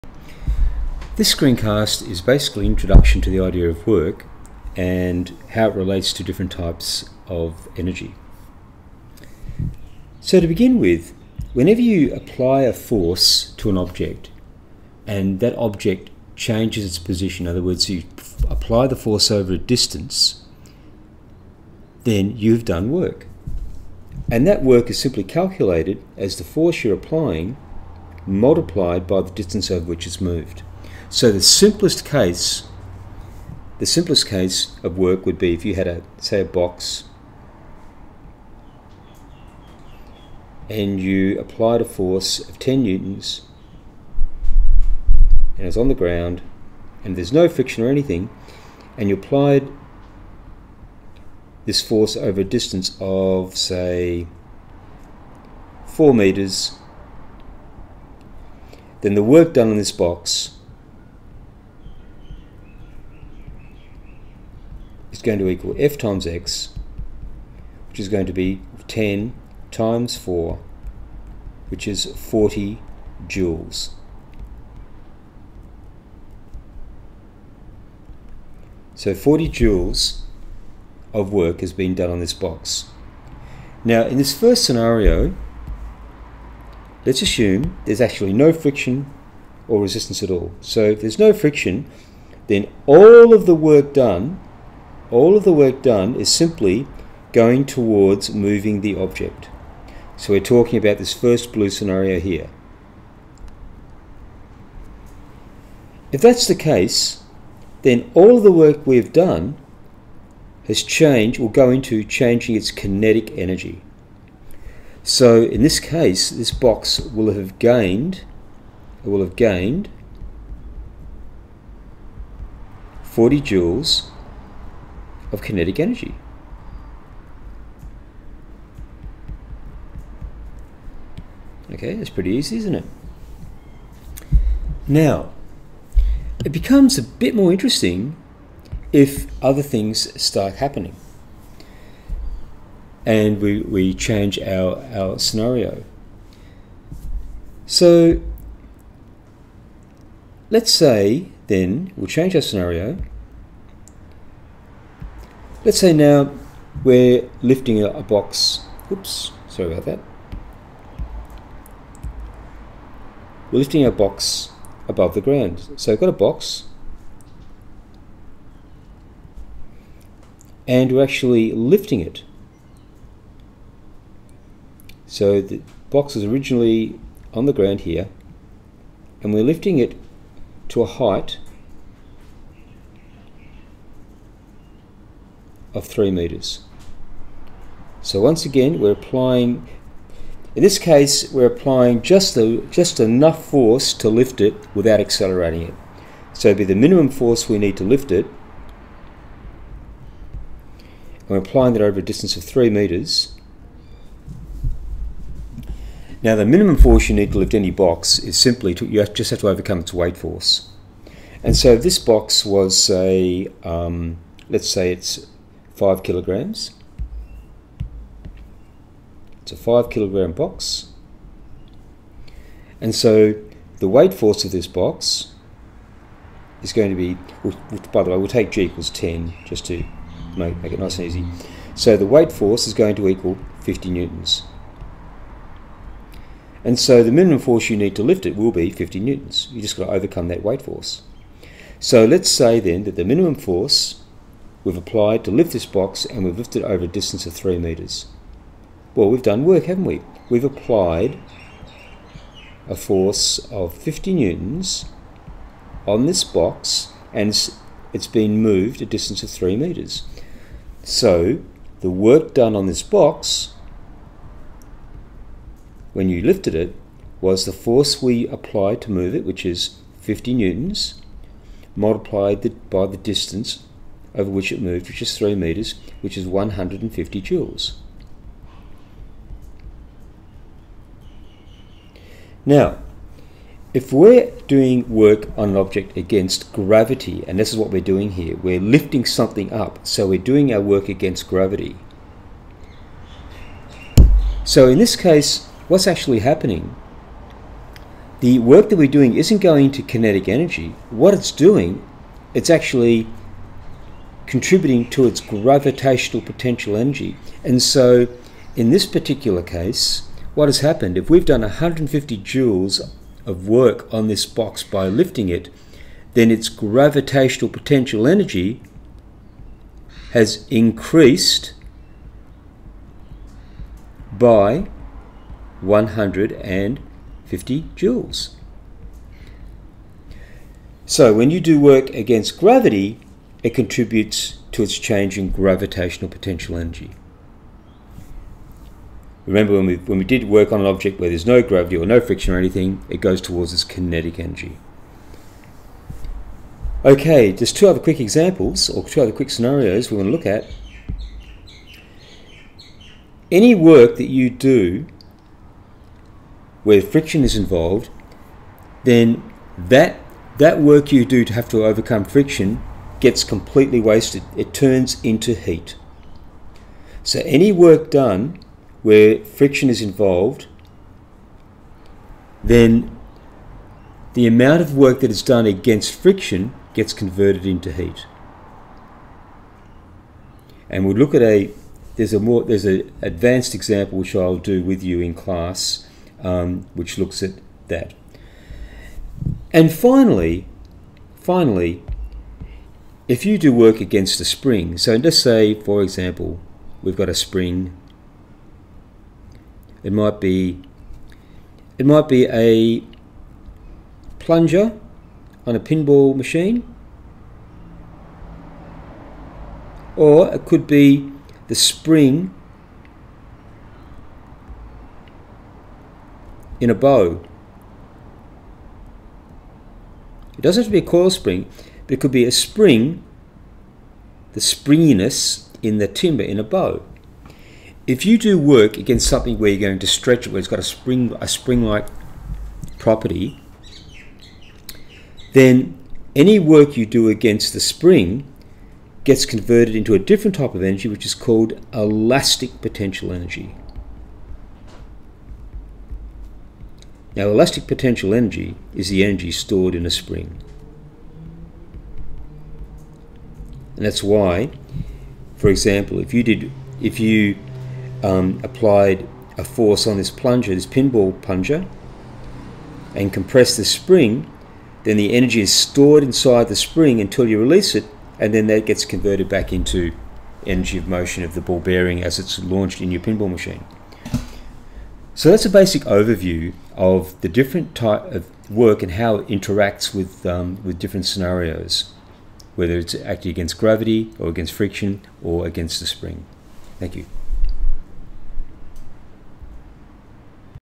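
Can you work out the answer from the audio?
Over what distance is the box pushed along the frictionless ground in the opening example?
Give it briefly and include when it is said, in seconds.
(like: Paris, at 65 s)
4 meters, at 55 s.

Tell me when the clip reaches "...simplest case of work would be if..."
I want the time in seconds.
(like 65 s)
33 s.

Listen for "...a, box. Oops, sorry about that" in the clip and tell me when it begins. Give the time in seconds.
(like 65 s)
157 s.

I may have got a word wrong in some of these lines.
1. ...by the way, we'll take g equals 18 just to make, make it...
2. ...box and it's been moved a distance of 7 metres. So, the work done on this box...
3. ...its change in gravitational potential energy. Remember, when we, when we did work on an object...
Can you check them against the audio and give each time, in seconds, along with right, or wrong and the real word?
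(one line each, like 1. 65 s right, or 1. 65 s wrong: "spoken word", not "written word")
1. 227 s wrong: "10", not "18"
2. 256 s wrong: "3", not "7"
3. 334 s right.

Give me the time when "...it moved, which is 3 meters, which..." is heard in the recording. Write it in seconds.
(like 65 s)
274 s.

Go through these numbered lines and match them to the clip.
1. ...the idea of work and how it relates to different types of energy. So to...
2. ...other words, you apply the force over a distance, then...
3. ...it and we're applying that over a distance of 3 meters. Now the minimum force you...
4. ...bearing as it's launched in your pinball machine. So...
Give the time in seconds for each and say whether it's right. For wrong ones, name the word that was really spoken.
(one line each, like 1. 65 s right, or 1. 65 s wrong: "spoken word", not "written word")
1. 3 s right
2. 17 s right
3. 198 s right
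4. 471 s right.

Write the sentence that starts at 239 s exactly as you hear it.
You just got to overcome that weight force.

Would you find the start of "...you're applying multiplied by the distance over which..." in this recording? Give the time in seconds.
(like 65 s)
26 s.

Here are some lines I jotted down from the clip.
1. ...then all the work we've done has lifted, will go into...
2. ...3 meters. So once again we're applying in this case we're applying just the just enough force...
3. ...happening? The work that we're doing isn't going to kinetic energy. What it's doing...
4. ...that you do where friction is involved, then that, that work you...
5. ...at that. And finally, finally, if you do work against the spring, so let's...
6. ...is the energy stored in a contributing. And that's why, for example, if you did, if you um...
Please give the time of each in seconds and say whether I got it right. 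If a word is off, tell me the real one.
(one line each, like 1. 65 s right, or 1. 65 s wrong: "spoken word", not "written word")
1. 107 s wrong: "changed", not "lifted"
2. 185 s right
3. 296 s right
4. 353 s right
5. 387 s right
6. 448 s wrong: "spring", not "contributing".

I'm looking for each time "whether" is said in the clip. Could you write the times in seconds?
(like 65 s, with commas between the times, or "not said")
482 s.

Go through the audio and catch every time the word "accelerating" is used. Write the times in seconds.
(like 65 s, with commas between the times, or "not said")
194 s.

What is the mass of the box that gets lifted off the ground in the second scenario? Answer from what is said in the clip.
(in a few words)
5 kilograms.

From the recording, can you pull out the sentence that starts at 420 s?
It doesn't have to be a coil spring.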